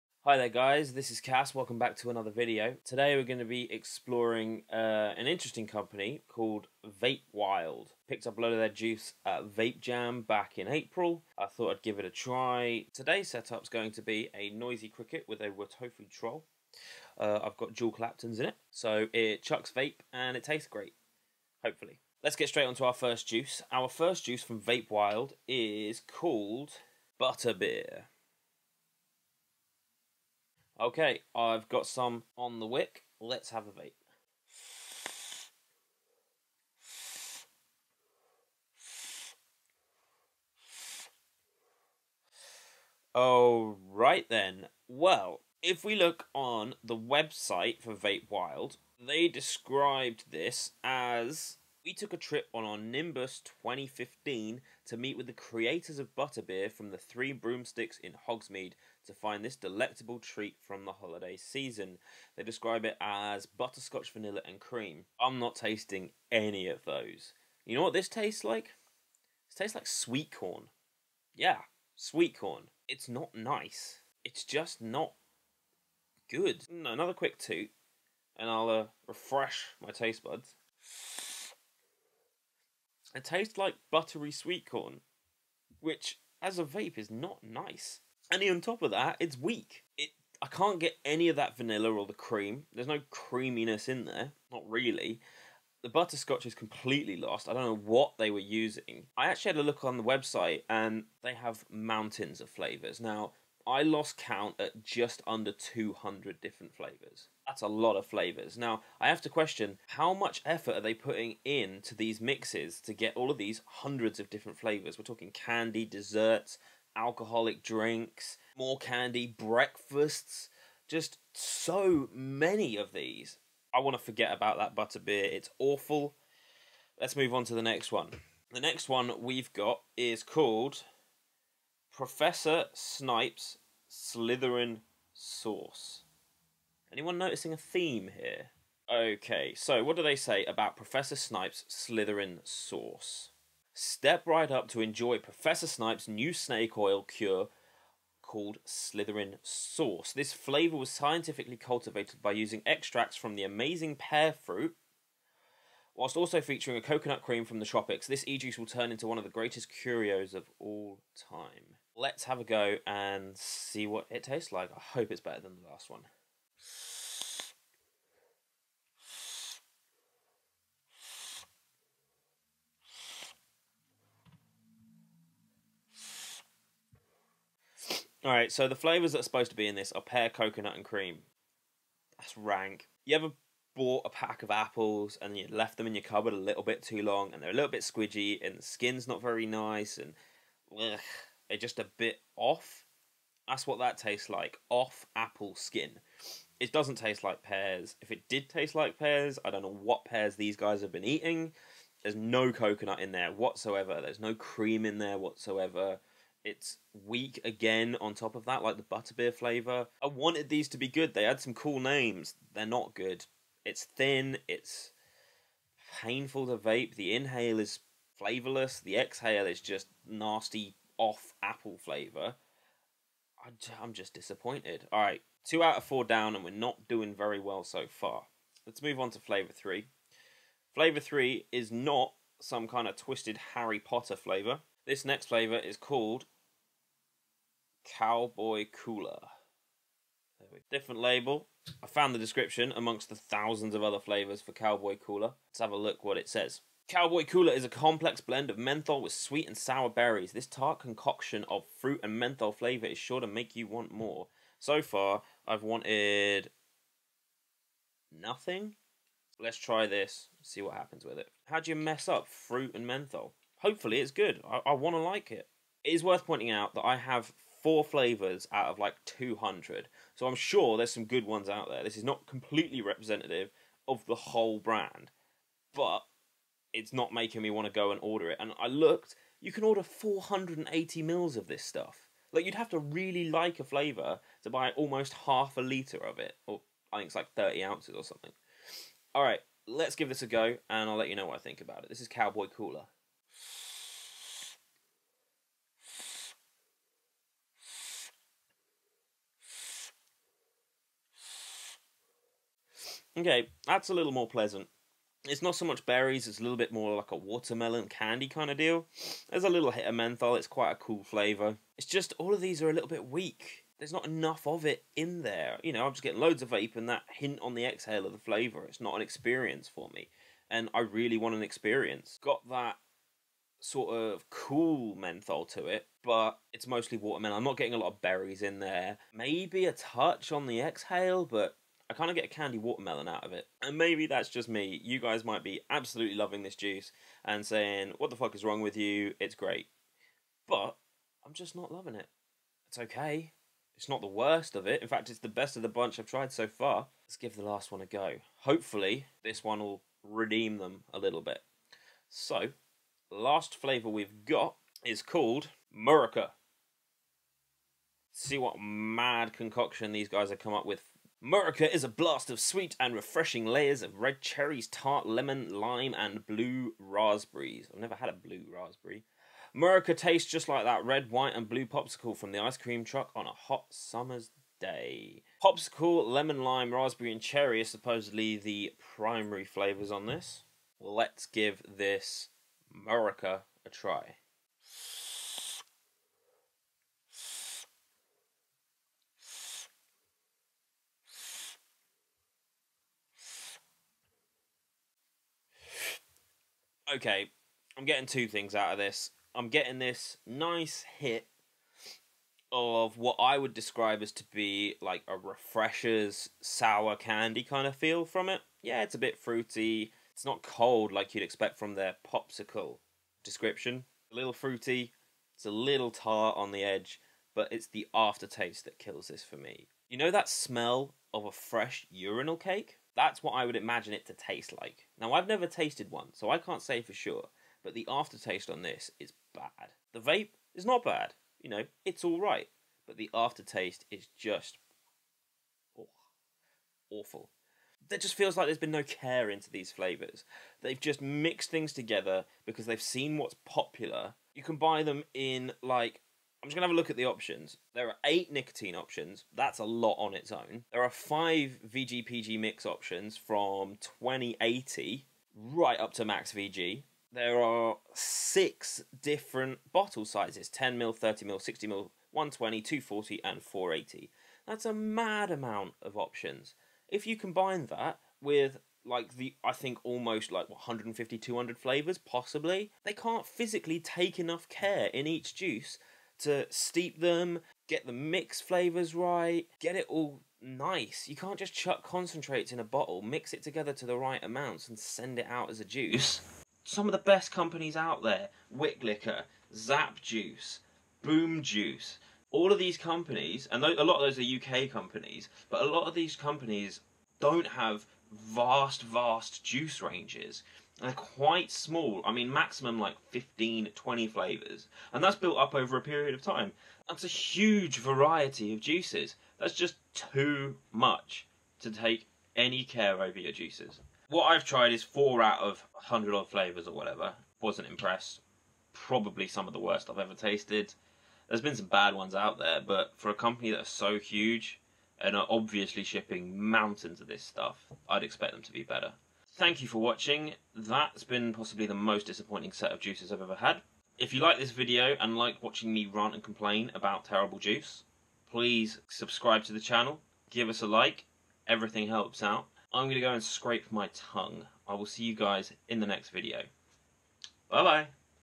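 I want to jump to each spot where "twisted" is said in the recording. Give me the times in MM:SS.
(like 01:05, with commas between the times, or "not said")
03:52.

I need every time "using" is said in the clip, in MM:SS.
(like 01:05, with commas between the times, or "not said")
01:38, 02:32.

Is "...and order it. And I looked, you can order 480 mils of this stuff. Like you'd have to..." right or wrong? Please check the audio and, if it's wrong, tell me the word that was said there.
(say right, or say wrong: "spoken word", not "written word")
right.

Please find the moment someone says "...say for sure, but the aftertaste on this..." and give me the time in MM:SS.
07:06.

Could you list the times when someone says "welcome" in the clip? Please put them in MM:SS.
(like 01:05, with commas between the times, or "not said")
00:01.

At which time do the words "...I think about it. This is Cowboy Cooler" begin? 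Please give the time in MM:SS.
04:51.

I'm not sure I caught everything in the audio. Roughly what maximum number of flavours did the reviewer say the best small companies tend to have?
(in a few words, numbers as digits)
15 to 20.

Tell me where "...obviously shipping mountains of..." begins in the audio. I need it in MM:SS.
08:45.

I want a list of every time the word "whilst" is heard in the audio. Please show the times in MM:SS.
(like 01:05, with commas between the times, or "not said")
02:35.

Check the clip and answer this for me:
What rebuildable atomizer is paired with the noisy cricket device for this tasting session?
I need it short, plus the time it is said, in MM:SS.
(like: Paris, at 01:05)
Wotofo troll, at 00:15.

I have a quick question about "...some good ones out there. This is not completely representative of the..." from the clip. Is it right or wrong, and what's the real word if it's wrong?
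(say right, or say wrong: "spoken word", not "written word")
right.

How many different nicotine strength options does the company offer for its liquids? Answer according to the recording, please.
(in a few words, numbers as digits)
8.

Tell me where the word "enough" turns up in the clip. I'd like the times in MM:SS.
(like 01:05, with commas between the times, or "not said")
05:14, 07:54.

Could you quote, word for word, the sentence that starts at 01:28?
And on top of that, it's weak.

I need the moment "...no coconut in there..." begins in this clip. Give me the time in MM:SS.
03:22.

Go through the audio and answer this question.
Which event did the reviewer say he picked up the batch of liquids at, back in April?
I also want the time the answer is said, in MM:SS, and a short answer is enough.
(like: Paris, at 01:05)
Vape Jam, at 00:09.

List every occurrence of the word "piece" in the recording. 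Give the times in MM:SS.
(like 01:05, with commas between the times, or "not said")
not said.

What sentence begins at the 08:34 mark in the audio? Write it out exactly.
What I've tried is four out of 100 odd flavours or whatever.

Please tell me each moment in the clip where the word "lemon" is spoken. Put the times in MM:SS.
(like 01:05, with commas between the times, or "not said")
06:05, 06:16.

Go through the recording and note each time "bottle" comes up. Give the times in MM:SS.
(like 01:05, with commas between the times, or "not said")
07:39, 08:02.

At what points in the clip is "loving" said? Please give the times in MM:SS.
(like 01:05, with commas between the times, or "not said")
05:36, 05:41.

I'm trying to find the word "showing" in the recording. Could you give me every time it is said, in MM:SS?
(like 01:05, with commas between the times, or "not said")
not said.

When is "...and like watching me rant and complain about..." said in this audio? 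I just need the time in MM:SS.
08:54.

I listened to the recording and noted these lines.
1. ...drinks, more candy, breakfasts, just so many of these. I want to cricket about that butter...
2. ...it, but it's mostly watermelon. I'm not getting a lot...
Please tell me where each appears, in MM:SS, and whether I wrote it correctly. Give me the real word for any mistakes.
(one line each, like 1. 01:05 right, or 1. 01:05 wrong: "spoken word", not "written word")
1. 01:57 wrong: "forget", not "cricket"
2. 05:25 right.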